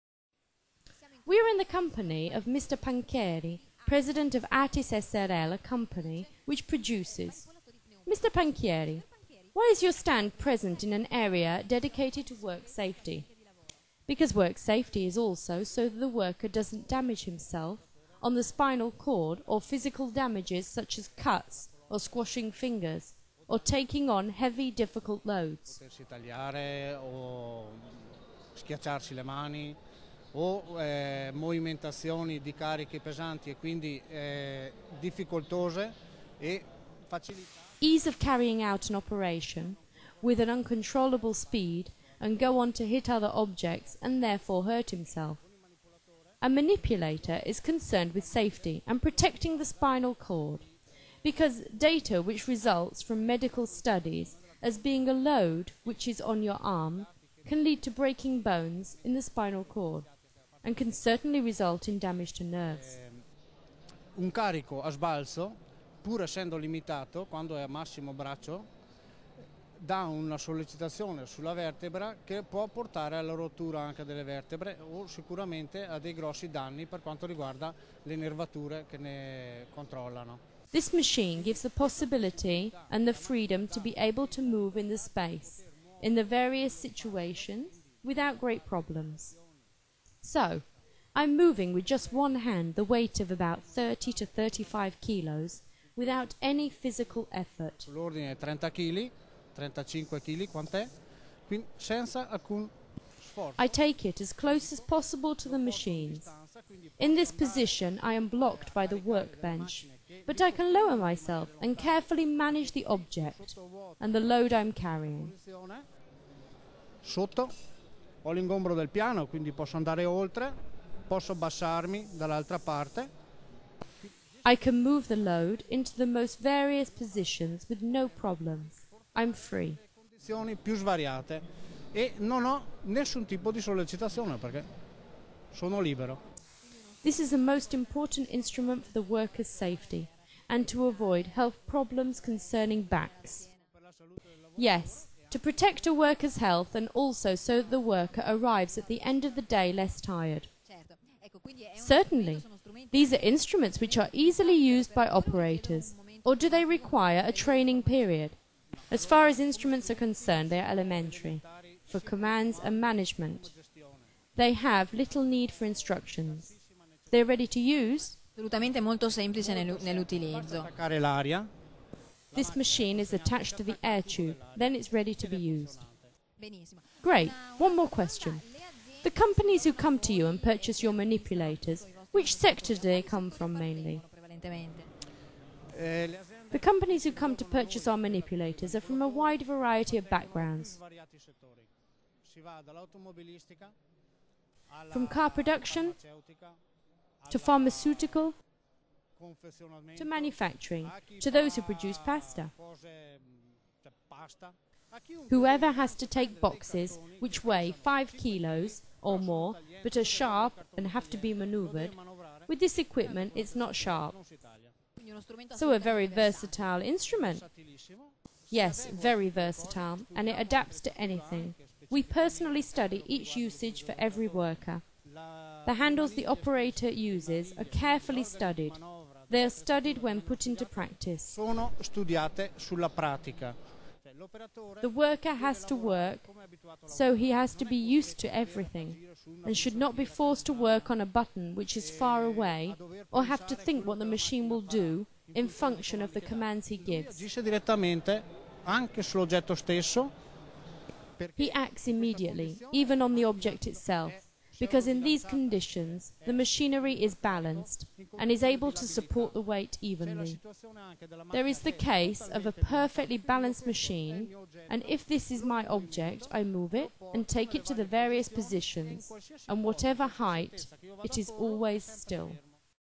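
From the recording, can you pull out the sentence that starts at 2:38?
As far as instruments are concerned, they are elementary, for commands and management.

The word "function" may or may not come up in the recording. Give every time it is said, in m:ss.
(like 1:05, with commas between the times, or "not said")
4:05.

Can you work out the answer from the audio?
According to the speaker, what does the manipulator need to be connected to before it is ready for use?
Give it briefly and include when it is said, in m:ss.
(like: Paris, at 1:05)
the air tube, at 2:53.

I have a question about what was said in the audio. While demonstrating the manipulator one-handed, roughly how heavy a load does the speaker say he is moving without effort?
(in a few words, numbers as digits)
30 to 35 kilos.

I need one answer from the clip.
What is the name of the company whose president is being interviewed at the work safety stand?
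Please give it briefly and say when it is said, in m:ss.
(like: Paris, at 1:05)
ATIS SRL, at 0:04.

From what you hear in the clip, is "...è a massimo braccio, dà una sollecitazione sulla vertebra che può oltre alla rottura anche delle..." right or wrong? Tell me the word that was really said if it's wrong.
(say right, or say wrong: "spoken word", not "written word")
wrong: "portare", not "oltre".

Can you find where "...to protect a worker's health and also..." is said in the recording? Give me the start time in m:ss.
2:25.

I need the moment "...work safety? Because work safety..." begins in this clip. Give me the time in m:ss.
0:12.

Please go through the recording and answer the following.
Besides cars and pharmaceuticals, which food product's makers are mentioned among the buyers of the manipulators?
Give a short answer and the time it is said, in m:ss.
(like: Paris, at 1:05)
pasta, at 3:21.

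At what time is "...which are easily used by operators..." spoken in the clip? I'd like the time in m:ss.
2:33.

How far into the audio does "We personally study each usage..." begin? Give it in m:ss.
3:41.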